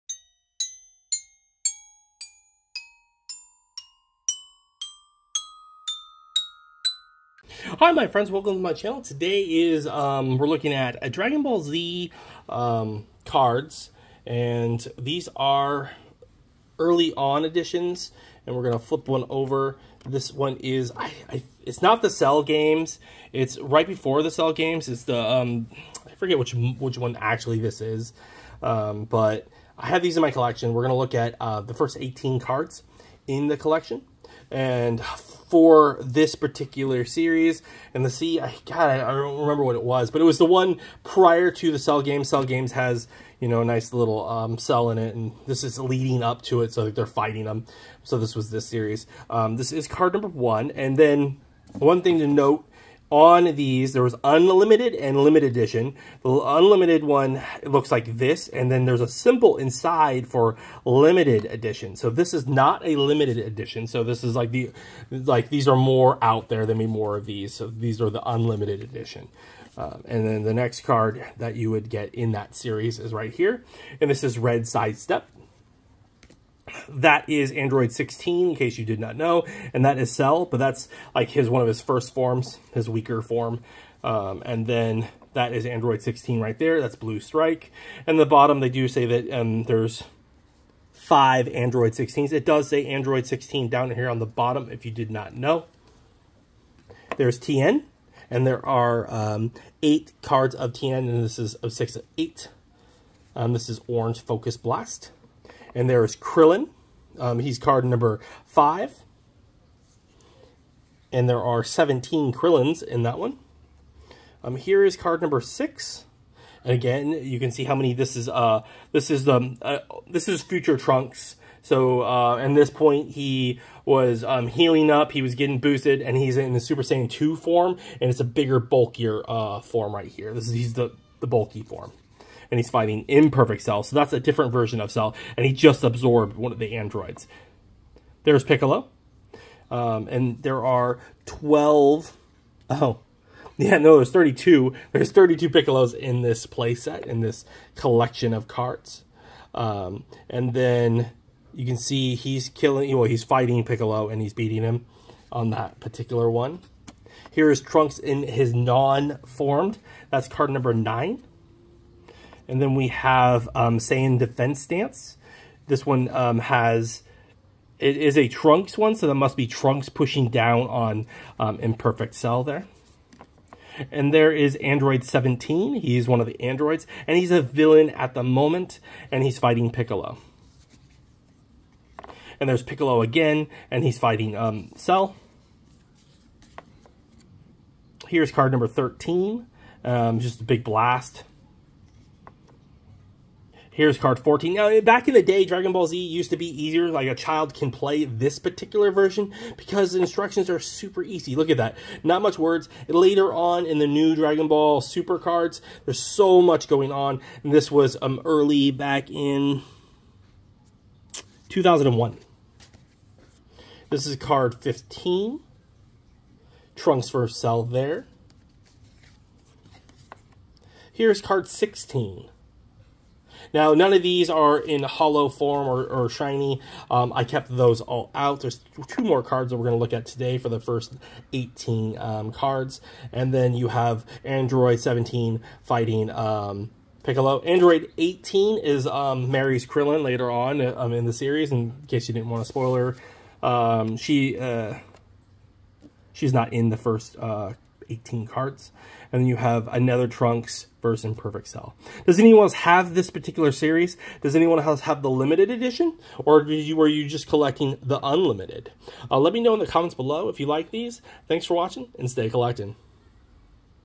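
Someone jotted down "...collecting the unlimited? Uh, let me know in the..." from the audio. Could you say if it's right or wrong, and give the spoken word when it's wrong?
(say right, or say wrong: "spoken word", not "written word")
right.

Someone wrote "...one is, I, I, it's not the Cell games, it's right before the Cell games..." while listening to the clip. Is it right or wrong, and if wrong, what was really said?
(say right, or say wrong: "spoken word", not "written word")
right.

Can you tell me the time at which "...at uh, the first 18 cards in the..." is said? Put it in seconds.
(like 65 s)
31 s.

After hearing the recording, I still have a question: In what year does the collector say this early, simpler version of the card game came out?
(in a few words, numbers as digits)
2001.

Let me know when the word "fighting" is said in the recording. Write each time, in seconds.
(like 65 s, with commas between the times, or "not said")
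47 s, 132 s, 153 s, 179 s, 183 s, 235 s.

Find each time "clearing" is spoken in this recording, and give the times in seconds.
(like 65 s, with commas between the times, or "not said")
not said.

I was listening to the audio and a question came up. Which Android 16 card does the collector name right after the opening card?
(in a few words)
Red Sidestep.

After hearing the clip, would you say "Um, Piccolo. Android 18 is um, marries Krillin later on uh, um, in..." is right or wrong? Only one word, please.
right.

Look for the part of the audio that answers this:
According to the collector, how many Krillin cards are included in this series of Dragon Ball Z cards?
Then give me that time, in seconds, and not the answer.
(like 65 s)
111 s.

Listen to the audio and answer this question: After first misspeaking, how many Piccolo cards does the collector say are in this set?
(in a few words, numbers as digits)
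32.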